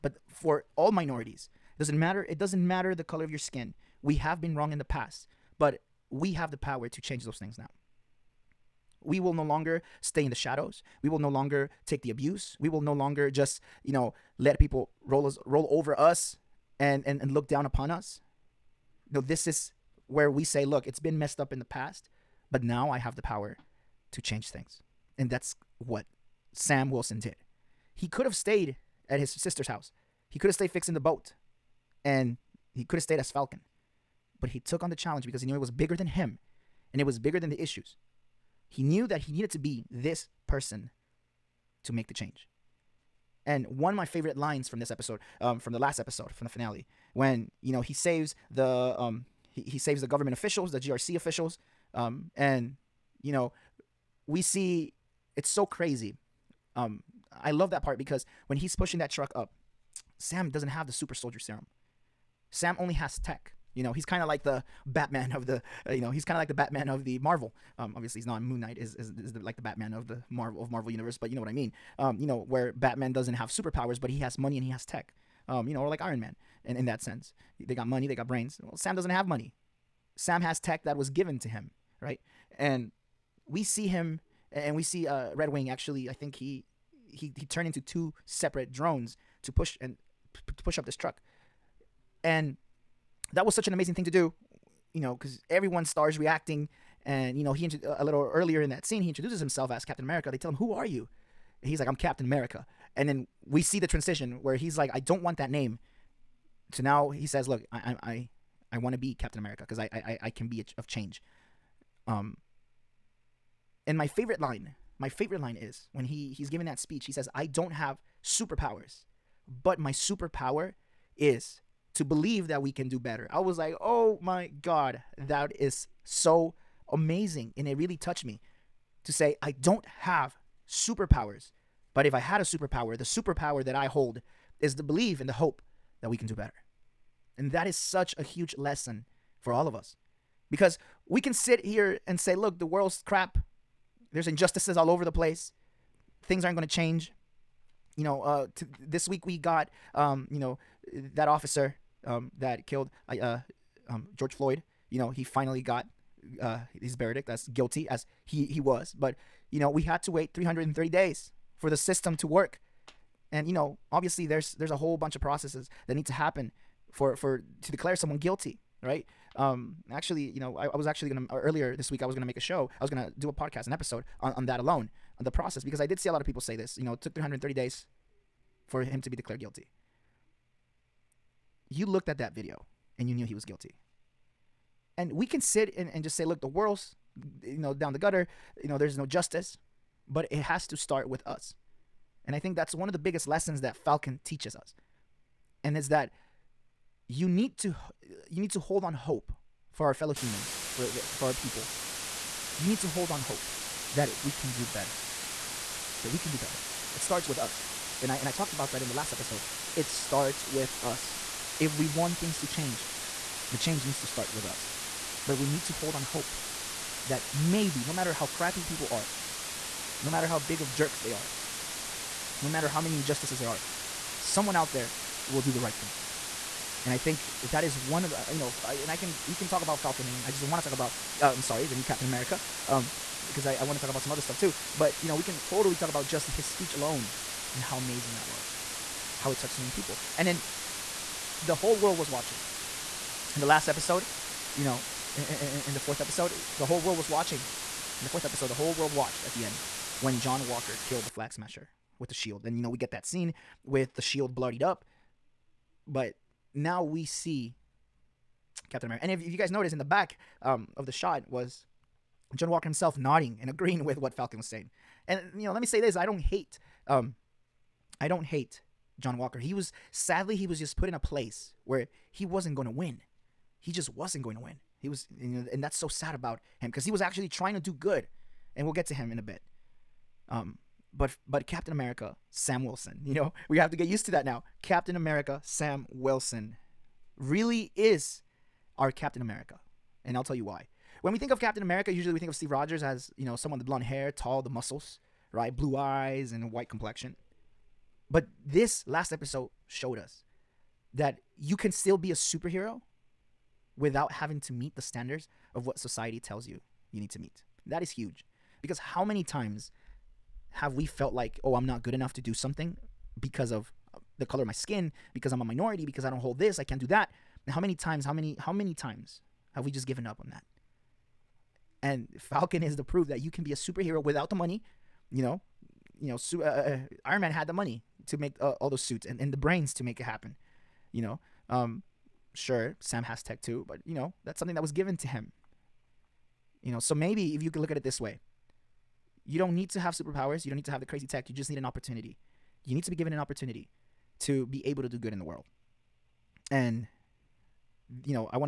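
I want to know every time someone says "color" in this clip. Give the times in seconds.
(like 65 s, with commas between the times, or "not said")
3 s, 314 s.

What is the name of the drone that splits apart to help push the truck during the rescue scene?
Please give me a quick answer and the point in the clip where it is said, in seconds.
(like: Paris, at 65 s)
Red Wing, at 85 s.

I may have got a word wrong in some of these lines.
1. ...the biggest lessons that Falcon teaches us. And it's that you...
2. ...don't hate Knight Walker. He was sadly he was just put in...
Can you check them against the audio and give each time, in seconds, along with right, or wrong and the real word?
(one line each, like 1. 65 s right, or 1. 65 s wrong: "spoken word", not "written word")
1. 192 s right
2. 268 s wrong: "John", not "Knight".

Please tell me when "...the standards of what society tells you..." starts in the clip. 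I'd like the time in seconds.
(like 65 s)
304 s.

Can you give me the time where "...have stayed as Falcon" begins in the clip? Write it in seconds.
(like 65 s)
32 s.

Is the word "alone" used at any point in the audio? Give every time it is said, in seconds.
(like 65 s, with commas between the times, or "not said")
174 s, 236 s.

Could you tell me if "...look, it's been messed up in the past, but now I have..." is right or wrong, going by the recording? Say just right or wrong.
right.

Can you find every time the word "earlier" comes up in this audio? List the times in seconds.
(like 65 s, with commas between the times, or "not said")
98 s, 171 s.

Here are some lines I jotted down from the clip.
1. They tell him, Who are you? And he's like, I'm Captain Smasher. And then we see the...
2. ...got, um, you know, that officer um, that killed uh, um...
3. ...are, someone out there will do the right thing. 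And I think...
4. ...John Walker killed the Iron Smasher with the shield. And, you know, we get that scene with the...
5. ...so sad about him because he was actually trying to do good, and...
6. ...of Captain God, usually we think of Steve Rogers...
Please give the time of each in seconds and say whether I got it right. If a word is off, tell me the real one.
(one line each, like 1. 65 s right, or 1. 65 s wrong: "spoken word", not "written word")
1. 100 s wrong: "America", not "Smasher"
2. 149 s right
3. 223 s right
4. 250 s wrong: "Flag", not "Iron"
5. 275 s right
6. 291 s wrong: "America", not "God".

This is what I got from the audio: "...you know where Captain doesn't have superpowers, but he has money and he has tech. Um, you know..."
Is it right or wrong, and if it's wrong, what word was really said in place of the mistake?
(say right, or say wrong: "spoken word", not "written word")
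wrong: "Batman", not "Captain".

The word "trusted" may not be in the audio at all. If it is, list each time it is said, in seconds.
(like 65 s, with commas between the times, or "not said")
not said.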